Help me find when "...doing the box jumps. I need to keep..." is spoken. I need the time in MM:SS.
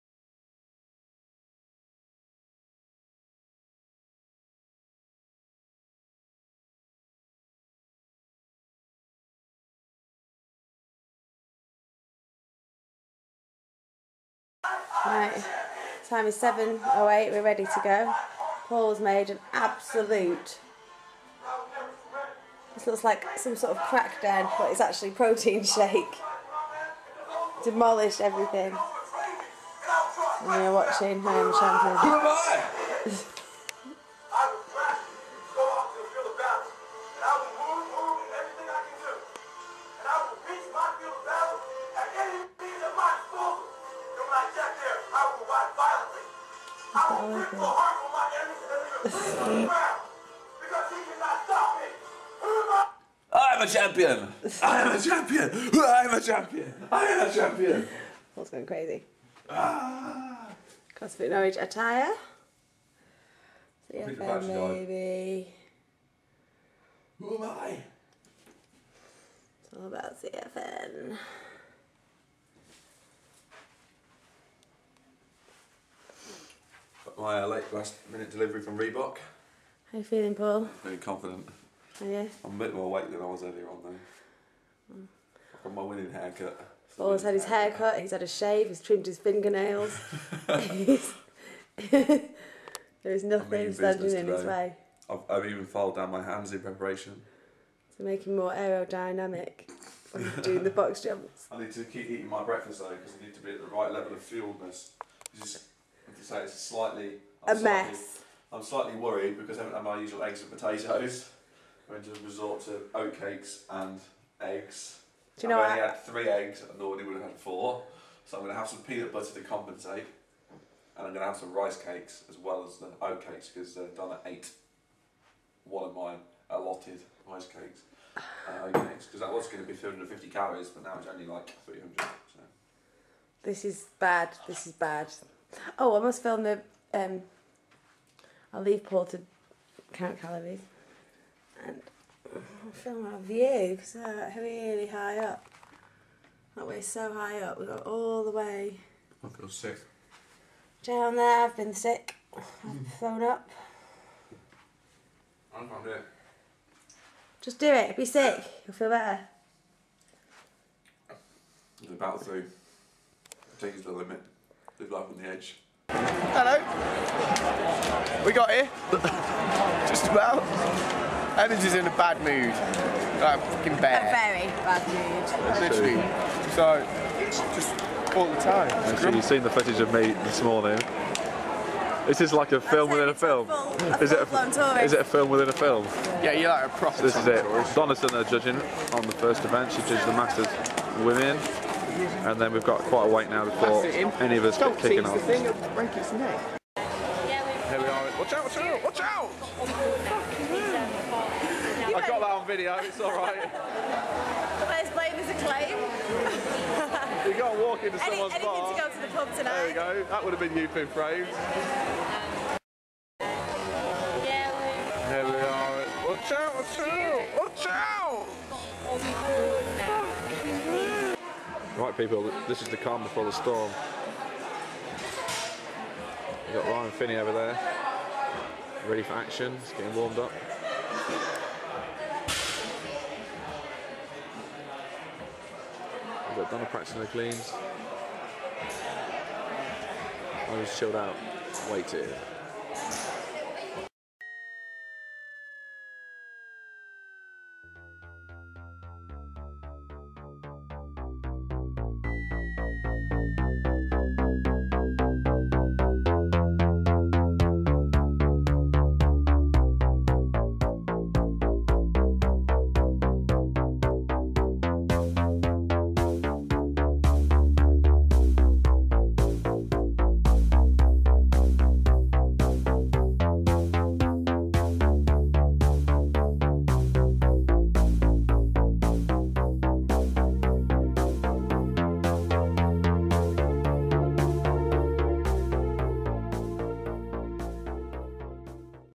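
01:40.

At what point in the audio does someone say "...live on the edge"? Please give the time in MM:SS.
02:44.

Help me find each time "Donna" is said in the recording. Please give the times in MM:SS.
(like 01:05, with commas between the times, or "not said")
02:03, 03:56.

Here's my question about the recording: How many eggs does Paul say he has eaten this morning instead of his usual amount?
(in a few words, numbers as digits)
3.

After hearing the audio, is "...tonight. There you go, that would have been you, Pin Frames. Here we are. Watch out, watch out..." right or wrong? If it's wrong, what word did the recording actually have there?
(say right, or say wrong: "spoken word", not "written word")
right.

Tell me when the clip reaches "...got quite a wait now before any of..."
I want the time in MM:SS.
03:12.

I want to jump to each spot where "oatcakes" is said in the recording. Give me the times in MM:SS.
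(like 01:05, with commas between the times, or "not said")
01:52, 02:03, 02:08.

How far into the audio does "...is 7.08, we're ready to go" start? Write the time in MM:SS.
00:16.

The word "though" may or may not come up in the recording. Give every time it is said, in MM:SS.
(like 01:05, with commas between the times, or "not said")
01:23, 01:42.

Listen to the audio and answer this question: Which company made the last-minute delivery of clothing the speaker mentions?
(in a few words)
Reebok.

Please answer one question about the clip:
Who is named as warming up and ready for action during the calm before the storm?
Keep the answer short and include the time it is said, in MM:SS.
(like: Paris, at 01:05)
Ryan Finney, at 03:46.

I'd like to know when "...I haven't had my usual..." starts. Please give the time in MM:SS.
01:49.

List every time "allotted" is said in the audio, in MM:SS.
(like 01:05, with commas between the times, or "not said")
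02:06.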